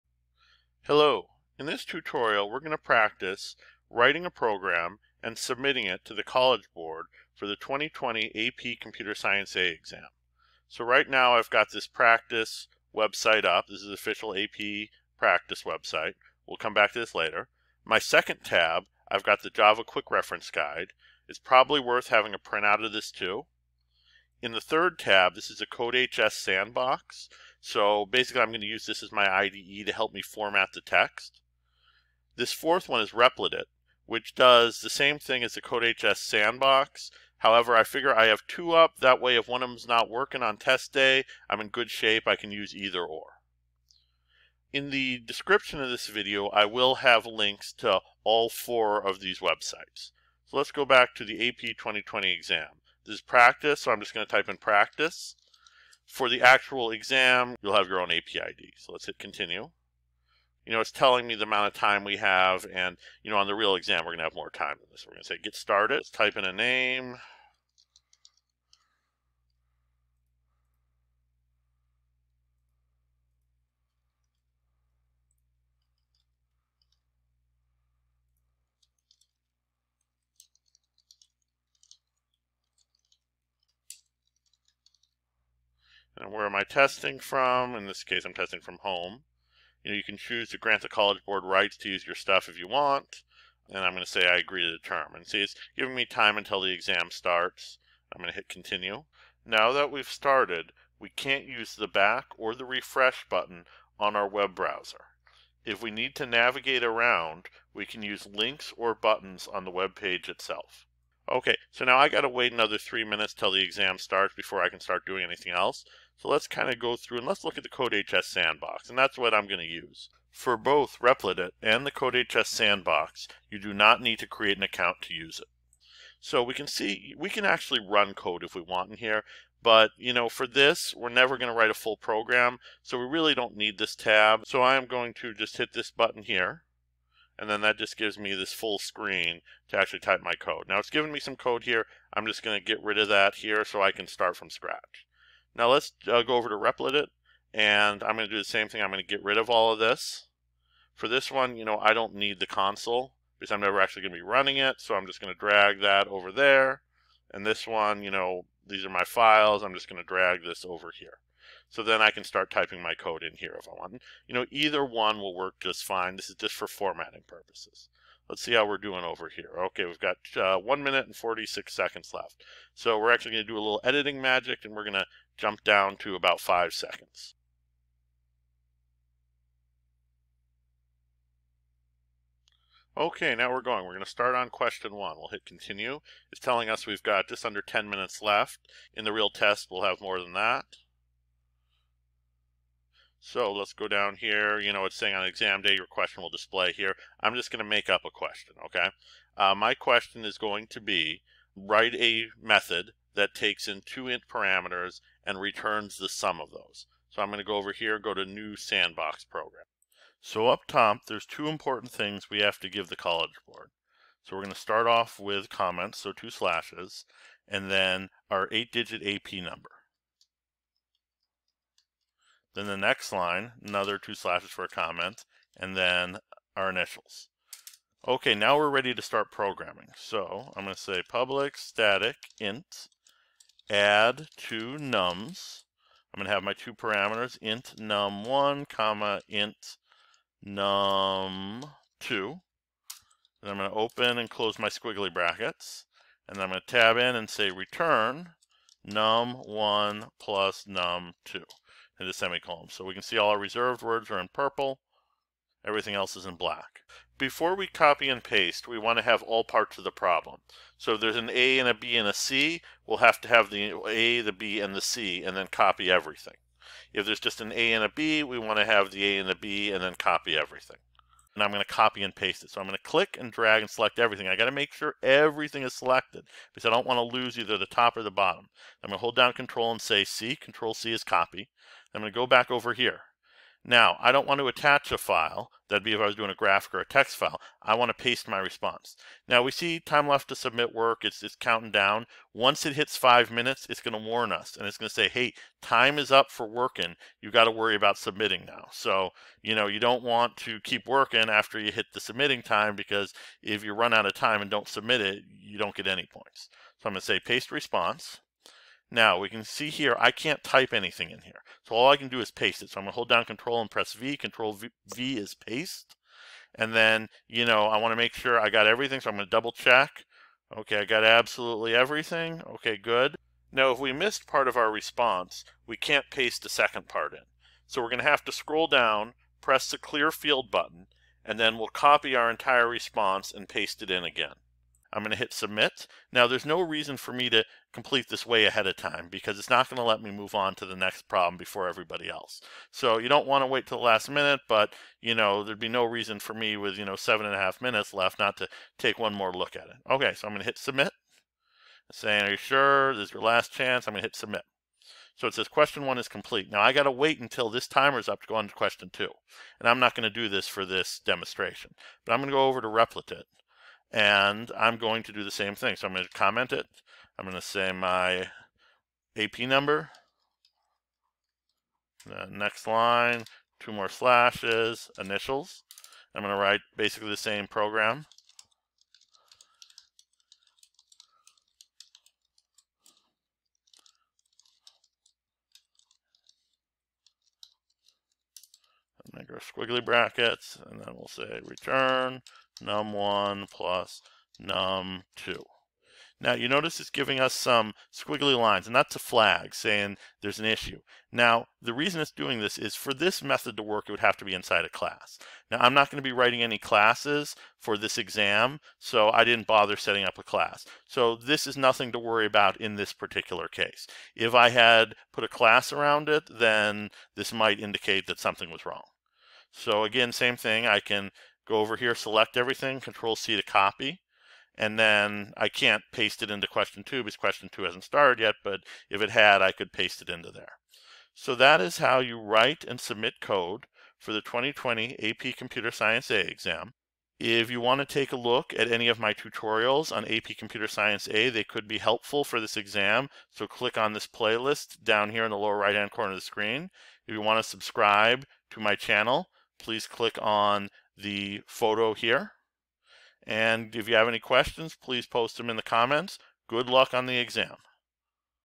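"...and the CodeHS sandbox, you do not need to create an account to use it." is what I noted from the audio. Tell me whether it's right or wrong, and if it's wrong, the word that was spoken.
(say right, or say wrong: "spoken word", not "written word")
right.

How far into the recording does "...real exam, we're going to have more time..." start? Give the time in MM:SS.
01:03.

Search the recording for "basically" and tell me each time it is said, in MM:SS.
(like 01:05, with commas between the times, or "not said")
00:28, 06:16.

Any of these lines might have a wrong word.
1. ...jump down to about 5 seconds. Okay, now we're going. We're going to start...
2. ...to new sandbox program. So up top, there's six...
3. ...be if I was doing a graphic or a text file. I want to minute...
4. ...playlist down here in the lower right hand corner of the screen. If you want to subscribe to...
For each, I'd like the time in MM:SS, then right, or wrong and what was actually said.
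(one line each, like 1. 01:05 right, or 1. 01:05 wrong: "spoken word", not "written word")
1. 02:55 right
2. 03:28 wrong: "two", not "six"
3. 04:45 wrong: "paste", not "minute"
4. 07:24 right.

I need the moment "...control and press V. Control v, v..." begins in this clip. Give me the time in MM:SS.
05:13.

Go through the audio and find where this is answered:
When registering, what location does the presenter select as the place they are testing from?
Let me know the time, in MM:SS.
01:28.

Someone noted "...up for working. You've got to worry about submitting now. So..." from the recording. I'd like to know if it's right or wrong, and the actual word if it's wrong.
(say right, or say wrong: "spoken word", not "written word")
right.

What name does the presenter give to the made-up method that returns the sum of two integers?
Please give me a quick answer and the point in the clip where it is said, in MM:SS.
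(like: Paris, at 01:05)
add two nums, at 03:53.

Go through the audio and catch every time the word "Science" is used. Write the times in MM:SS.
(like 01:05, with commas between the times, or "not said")
00:09, 07:15, 07:20.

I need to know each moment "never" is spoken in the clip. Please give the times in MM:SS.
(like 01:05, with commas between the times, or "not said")
02:11, 02:33.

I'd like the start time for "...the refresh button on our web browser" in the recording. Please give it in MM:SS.
01:42.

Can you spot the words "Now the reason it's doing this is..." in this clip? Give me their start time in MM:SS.
06:41.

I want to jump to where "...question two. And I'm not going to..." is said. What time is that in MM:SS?
05:58.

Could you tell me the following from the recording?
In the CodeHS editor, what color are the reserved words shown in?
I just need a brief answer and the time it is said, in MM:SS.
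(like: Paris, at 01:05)
purple, at 04:14.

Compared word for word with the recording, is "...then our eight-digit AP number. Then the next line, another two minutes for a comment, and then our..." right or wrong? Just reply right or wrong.
wrong.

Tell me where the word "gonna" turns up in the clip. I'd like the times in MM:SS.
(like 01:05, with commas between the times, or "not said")
05:12, 05:19, 05:27.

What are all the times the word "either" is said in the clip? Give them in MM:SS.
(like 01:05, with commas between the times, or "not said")
00:42, 02:44, 04:37.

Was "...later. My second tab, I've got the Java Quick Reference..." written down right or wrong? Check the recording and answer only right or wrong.
right.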